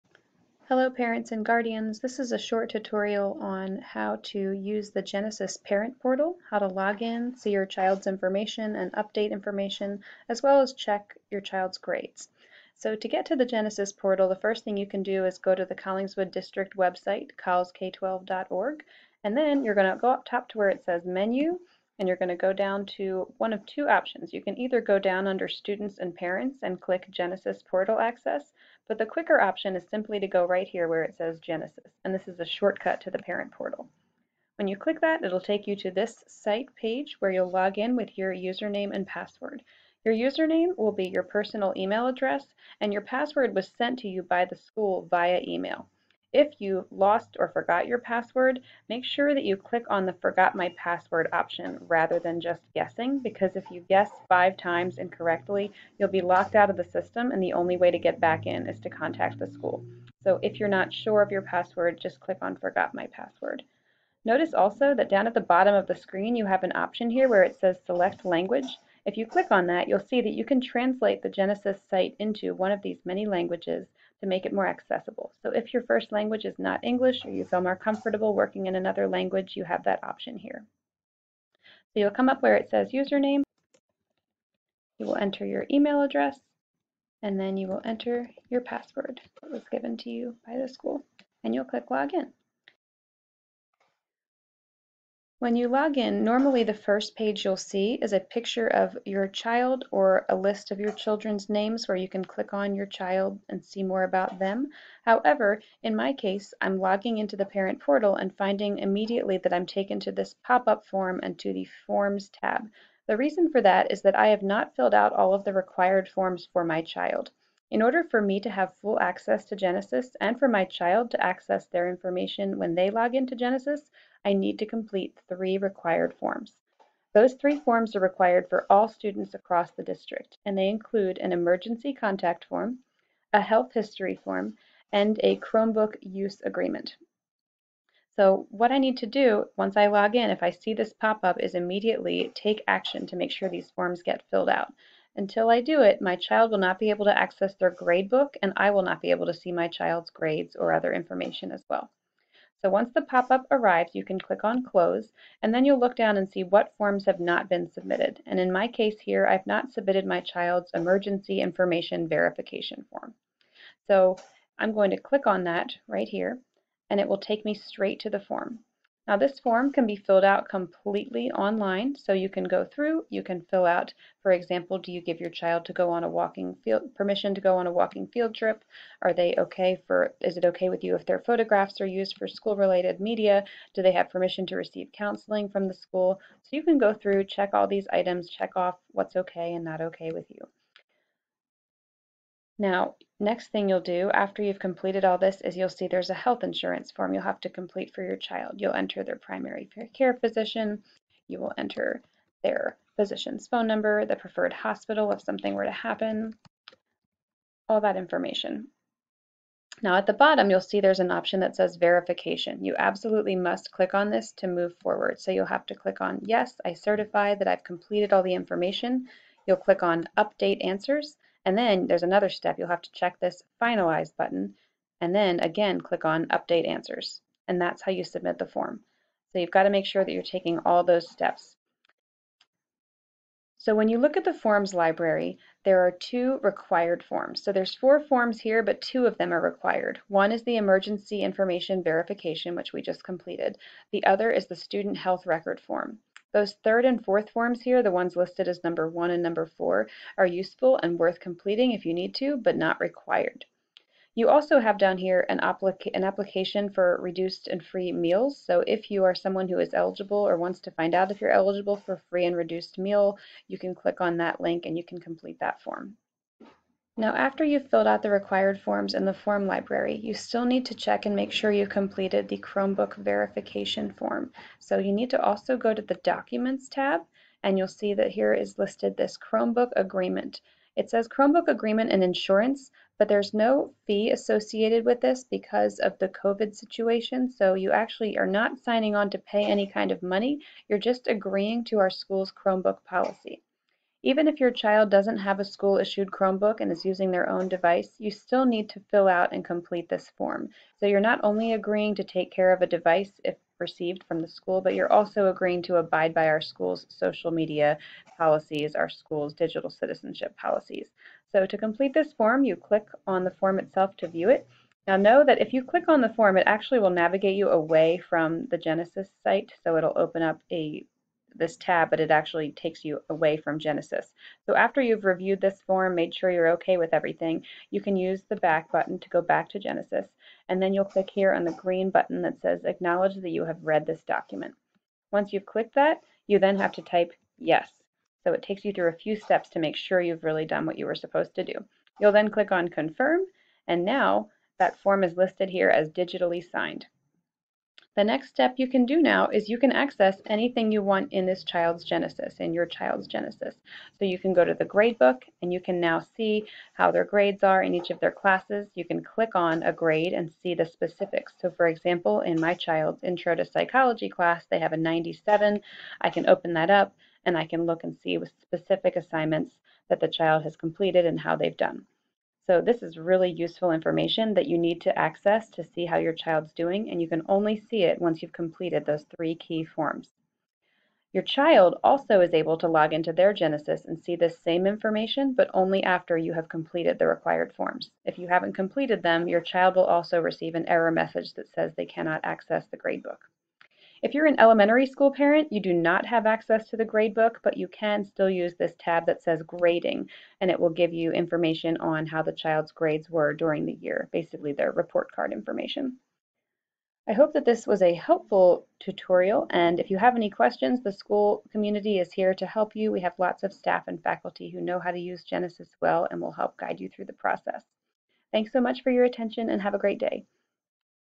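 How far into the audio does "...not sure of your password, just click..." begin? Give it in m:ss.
1:00.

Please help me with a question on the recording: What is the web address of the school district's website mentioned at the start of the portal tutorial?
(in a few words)
collsk12.org.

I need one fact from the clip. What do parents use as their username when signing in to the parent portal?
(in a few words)
personal email address.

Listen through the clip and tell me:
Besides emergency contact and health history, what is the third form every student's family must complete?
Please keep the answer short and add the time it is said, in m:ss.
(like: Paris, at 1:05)
Chromebook use agreement, at 2:15.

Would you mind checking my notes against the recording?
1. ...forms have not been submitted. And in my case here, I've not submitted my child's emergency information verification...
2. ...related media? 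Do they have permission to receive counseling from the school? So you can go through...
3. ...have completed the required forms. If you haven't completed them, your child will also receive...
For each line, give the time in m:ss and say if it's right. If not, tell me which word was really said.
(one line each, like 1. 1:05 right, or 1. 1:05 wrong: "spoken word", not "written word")
1. 2:36 right
2. 3:02 right
3. 6:26 right.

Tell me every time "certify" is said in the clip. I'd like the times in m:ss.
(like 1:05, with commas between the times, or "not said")
3:36.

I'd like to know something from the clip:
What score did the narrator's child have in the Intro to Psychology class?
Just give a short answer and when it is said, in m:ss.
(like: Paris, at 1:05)
97, at 6:04.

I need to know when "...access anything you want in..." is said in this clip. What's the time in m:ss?
5:49.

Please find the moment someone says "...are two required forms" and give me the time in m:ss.
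3:55.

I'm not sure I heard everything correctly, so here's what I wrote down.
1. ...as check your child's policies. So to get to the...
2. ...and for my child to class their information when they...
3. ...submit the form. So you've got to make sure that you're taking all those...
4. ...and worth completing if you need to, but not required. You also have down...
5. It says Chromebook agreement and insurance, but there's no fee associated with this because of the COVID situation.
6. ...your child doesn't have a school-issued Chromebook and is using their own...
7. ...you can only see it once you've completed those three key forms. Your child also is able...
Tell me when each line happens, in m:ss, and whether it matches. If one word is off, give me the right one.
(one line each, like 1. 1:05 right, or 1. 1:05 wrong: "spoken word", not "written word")
1. 0:10 wrong: "grades", not "policies"
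2. 2:00 wrong: "access", not "class"
3. 3:48 right
4. 4:10 right
5. 4:40 right
6. 4:54 right
7. 6:16 right.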